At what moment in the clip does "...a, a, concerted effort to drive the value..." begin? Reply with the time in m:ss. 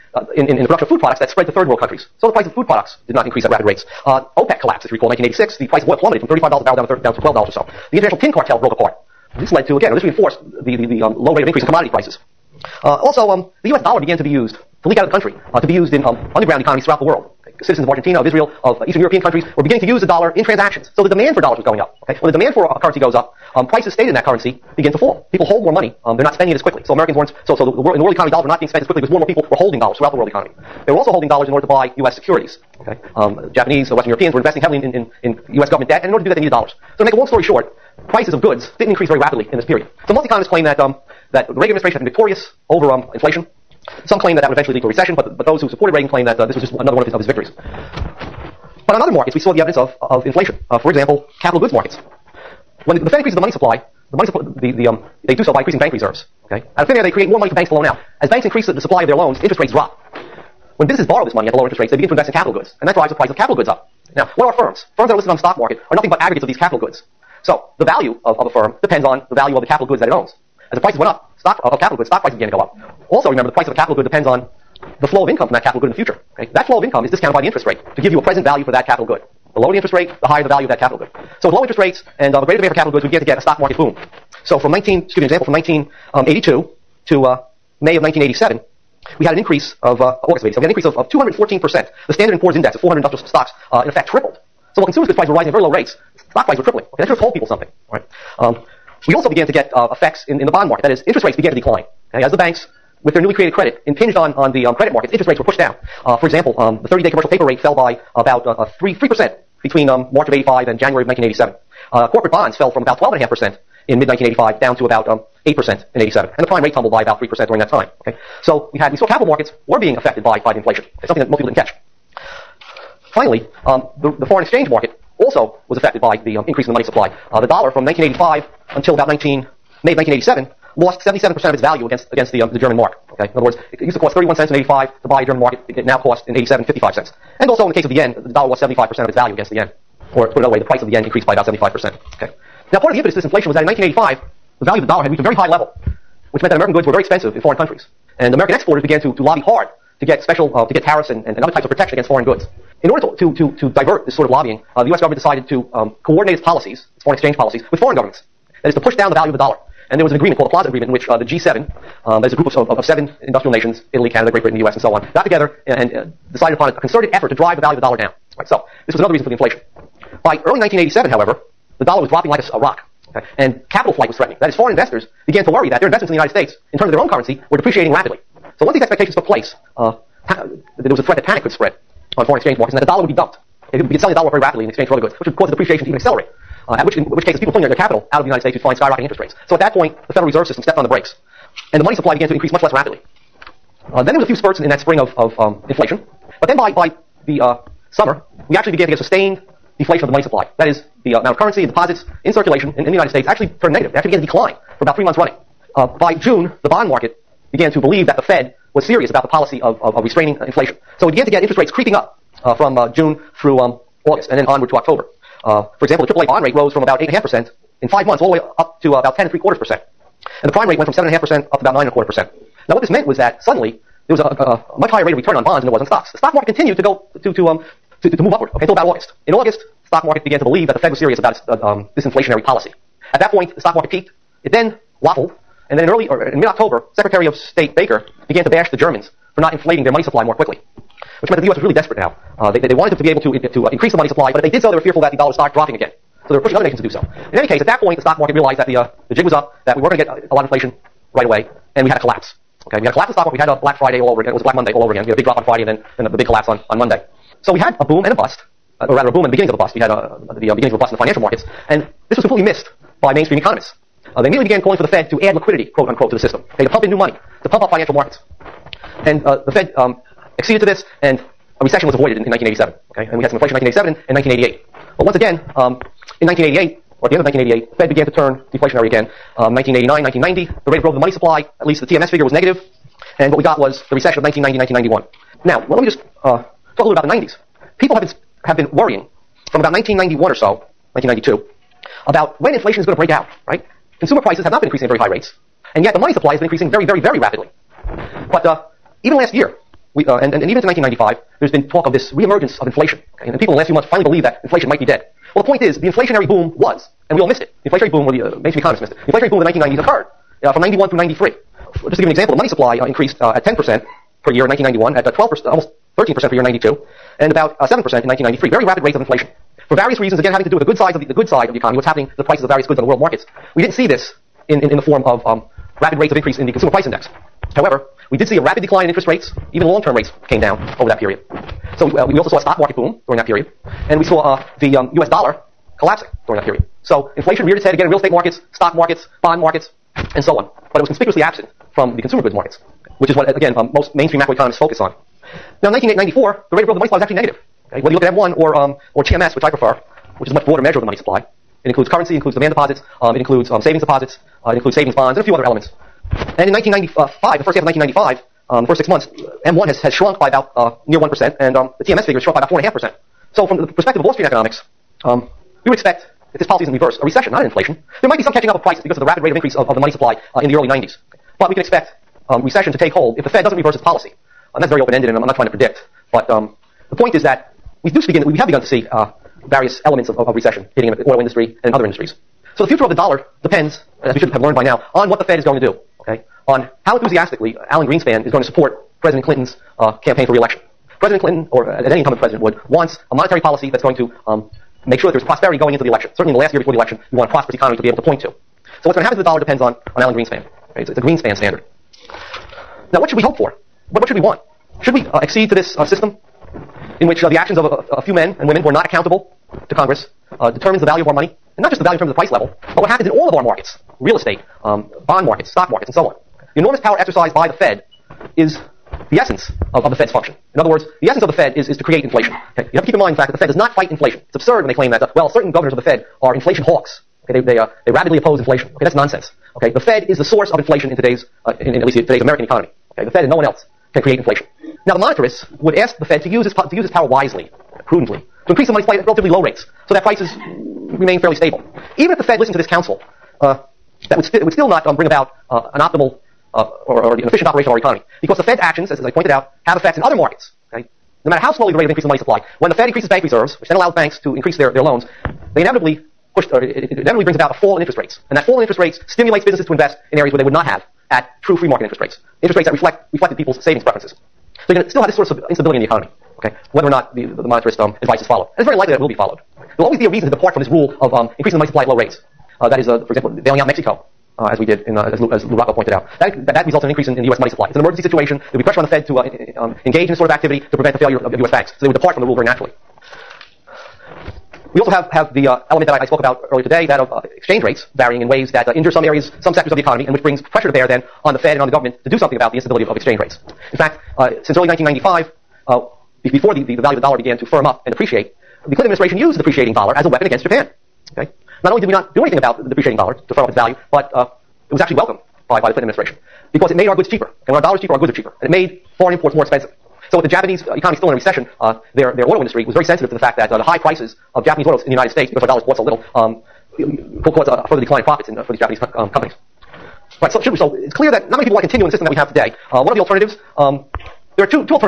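2:46.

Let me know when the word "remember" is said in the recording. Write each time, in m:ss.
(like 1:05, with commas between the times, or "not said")
1:13.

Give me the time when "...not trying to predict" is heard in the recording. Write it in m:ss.
6:15.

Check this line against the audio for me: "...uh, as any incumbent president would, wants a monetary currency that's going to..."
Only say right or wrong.
wrong.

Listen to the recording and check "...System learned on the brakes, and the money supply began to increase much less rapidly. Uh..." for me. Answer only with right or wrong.
wrong.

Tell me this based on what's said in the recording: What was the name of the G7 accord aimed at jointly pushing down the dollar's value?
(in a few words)
Plaza Agreement.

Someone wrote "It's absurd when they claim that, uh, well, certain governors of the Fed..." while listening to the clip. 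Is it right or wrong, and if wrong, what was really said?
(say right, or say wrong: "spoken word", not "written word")
right.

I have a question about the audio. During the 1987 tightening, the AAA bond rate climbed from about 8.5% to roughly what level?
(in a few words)
10.75%.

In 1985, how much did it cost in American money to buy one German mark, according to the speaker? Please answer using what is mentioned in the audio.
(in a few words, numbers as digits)
31 cents.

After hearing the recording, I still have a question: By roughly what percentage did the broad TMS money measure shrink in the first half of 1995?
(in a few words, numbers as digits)
4.5%.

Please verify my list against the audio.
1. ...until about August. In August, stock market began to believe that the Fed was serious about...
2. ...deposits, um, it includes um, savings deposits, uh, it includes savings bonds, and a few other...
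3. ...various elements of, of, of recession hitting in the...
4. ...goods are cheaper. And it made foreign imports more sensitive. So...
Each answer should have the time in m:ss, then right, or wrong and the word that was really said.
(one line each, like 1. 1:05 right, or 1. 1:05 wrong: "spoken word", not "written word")
1. 3:48 right
2. 5:52 right
3. 6:19 right
4. 8:27 wrong: "expensive", not "sensitive".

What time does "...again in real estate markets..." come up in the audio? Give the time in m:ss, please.
5:37.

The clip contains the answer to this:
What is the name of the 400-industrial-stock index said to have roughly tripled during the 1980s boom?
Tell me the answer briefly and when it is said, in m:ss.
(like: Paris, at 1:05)
Standard and Poor's, at 1:32.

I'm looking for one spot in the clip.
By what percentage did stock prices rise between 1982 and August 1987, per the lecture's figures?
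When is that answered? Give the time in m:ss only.
1:31.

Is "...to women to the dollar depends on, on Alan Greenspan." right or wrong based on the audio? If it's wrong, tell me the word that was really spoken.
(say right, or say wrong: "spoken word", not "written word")
wrong: "happen", not "women".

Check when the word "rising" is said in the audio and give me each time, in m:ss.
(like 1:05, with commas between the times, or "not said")
1:35.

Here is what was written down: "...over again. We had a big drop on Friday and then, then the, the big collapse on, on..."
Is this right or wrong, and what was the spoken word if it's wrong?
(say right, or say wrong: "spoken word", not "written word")
right.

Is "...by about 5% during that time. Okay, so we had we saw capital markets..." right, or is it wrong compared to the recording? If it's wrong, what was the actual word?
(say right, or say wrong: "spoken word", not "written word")
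wrong: "3", not "5".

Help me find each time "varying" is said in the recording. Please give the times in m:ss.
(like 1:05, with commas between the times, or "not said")
8:07.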